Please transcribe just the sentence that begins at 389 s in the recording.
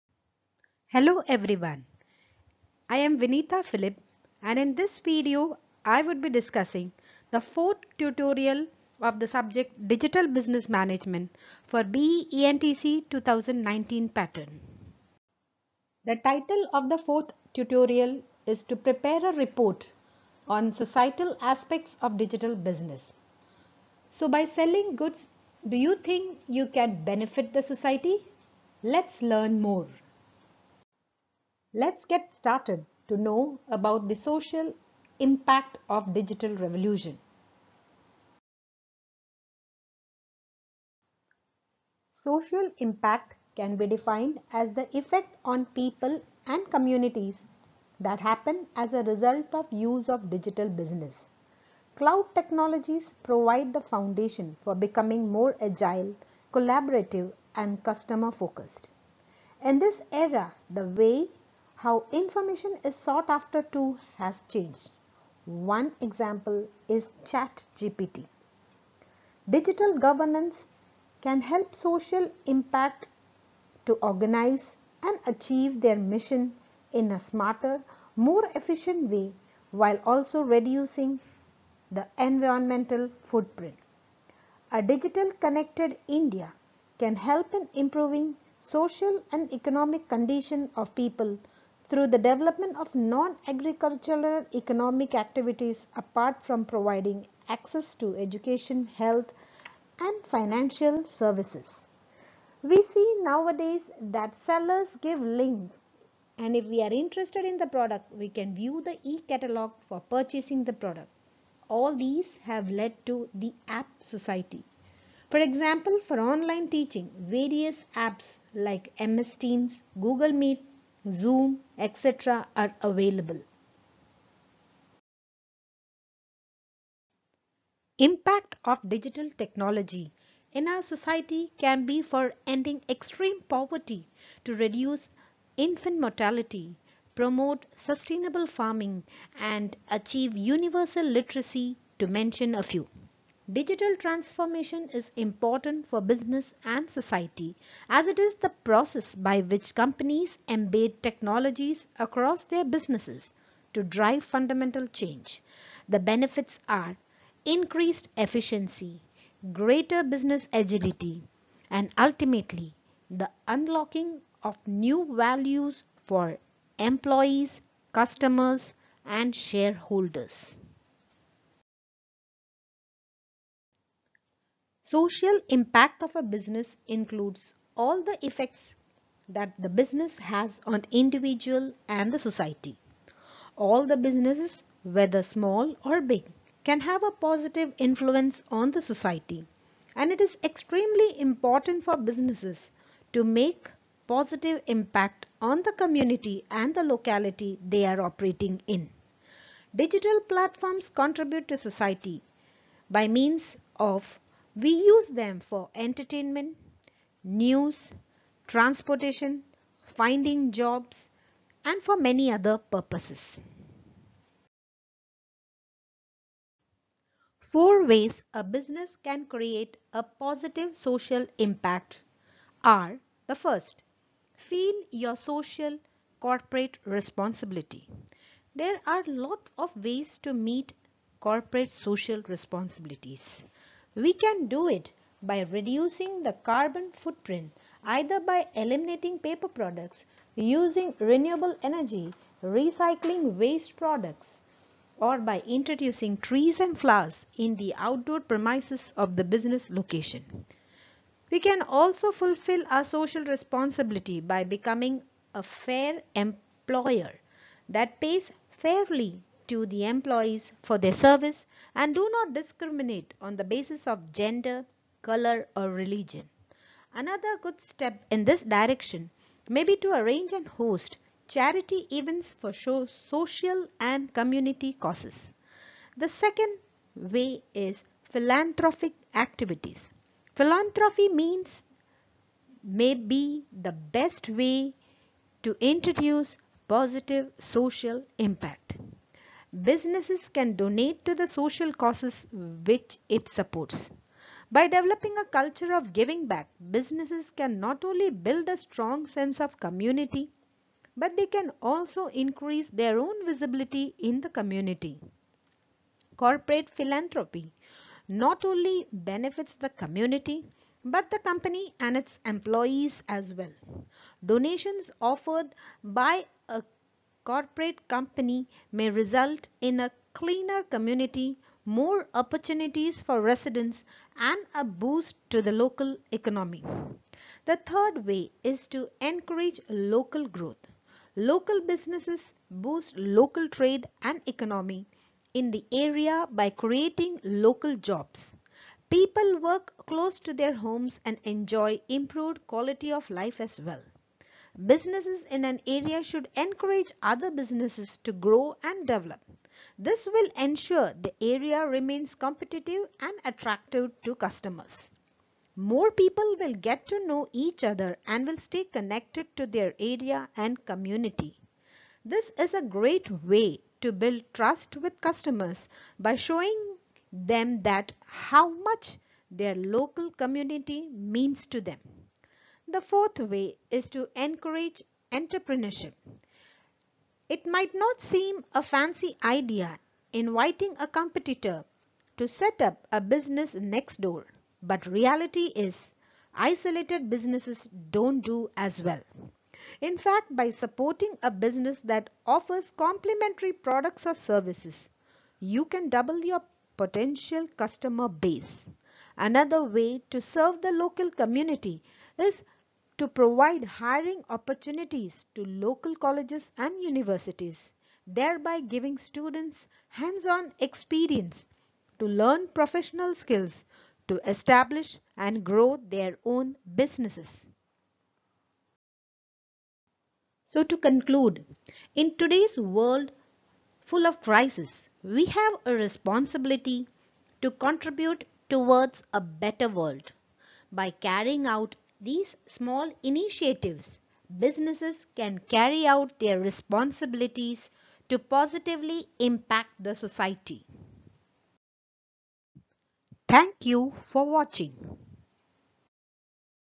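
In fact, by supporting a business that offers complementary products or services, you can double your potential customer base.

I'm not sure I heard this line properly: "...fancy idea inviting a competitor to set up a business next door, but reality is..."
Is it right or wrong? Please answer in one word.
right.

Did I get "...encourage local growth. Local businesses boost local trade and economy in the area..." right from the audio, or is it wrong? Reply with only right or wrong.
right.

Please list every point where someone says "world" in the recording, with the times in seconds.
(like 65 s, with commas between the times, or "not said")
422 s, 429 s.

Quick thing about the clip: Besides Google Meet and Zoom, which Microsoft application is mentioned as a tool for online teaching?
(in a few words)
MS Teams.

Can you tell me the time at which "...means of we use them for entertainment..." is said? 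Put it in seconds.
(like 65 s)
203 s.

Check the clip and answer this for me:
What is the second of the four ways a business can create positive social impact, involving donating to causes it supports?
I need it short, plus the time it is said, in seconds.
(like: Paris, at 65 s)
Philanthropic activities, at 278 s.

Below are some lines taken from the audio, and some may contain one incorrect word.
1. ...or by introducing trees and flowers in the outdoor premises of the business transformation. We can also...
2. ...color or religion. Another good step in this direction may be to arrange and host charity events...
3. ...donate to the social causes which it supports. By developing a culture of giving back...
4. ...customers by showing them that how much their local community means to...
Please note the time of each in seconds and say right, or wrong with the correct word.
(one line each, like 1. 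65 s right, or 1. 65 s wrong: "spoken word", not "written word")
1. 244 s wrong: "location", not "transformation"
2. 265 s right
3. 290 s right
4. 364 s right.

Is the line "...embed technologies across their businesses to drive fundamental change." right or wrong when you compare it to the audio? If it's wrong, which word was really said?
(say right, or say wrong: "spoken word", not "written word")
right.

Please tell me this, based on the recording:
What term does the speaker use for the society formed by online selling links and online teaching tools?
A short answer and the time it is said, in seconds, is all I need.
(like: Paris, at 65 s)
app society, at 113 s.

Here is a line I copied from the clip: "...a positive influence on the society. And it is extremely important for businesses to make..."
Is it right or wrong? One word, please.
right.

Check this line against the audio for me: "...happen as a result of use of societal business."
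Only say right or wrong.
wrong.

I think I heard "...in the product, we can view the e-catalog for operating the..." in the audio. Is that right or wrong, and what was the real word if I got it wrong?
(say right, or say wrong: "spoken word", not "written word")
wrong: "purchasing", not "operating".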